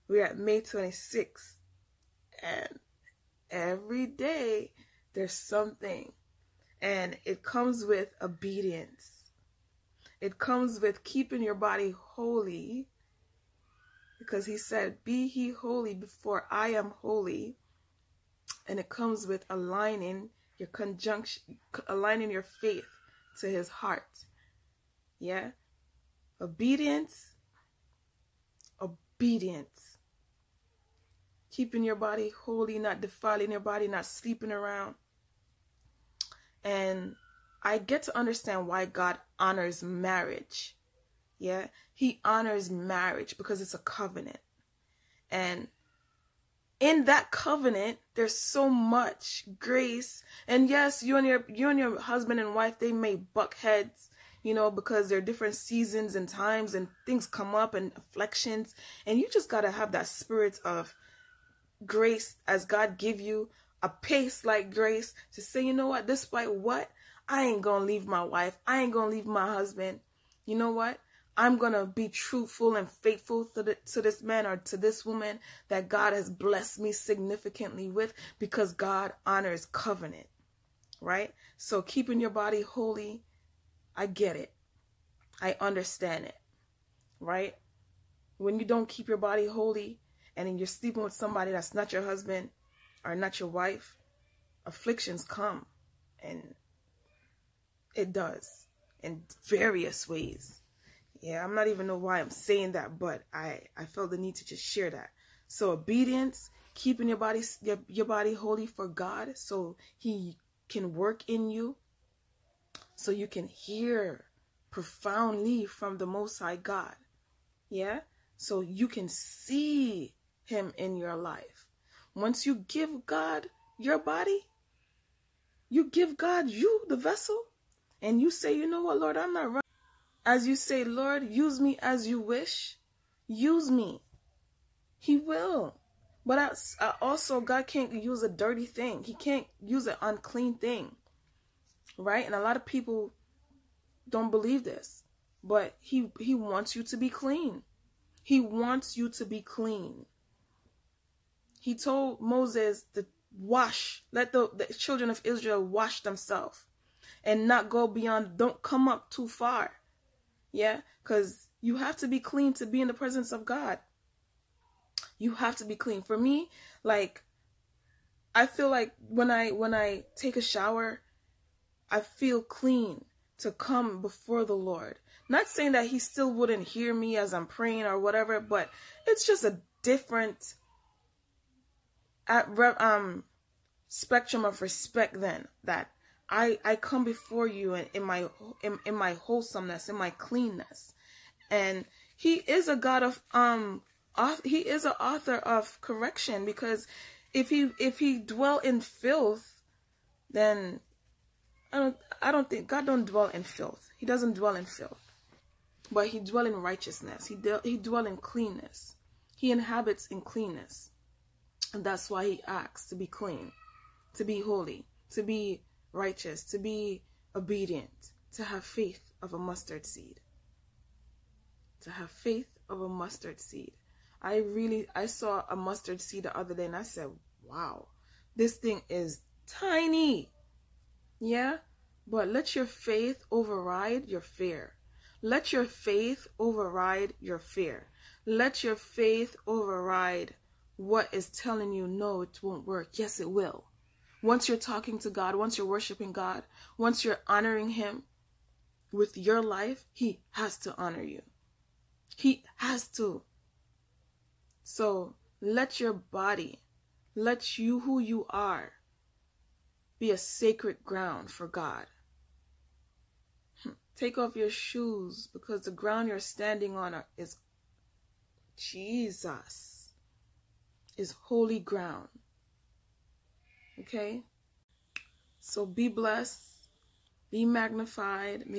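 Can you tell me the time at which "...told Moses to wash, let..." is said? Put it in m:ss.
2:31.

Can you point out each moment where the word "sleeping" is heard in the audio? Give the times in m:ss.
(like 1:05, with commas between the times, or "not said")
0:34, 1:30.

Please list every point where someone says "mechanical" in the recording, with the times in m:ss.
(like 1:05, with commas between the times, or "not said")
not said.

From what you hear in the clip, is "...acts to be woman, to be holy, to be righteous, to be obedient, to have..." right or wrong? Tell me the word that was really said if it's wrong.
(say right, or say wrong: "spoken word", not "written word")
wrong: "clean", not "woman".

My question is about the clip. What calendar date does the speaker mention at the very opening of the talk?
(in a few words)
May 26.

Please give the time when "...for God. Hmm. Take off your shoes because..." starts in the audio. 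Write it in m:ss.
4:21.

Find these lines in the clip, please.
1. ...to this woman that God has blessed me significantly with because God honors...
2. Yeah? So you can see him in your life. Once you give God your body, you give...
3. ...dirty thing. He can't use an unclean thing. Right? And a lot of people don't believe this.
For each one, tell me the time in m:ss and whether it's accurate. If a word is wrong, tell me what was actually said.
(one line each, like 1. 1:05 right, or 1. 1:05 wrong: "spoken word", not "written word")
1. 1:14 right
2. 1:57 right
3. 2:18 right.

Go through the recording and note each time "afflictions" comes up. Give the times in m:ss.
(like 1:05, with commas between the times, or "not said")
0:57, 1:34.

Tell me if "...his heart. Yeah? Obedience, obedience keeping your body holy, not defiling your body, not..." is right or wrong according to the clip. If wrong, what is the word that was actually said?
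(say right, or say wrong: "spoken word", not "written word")
right.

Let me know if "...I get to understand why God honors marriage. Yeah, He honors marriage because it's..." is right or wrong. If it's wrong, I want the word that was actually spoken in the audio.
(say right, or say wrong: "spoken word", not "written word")
right.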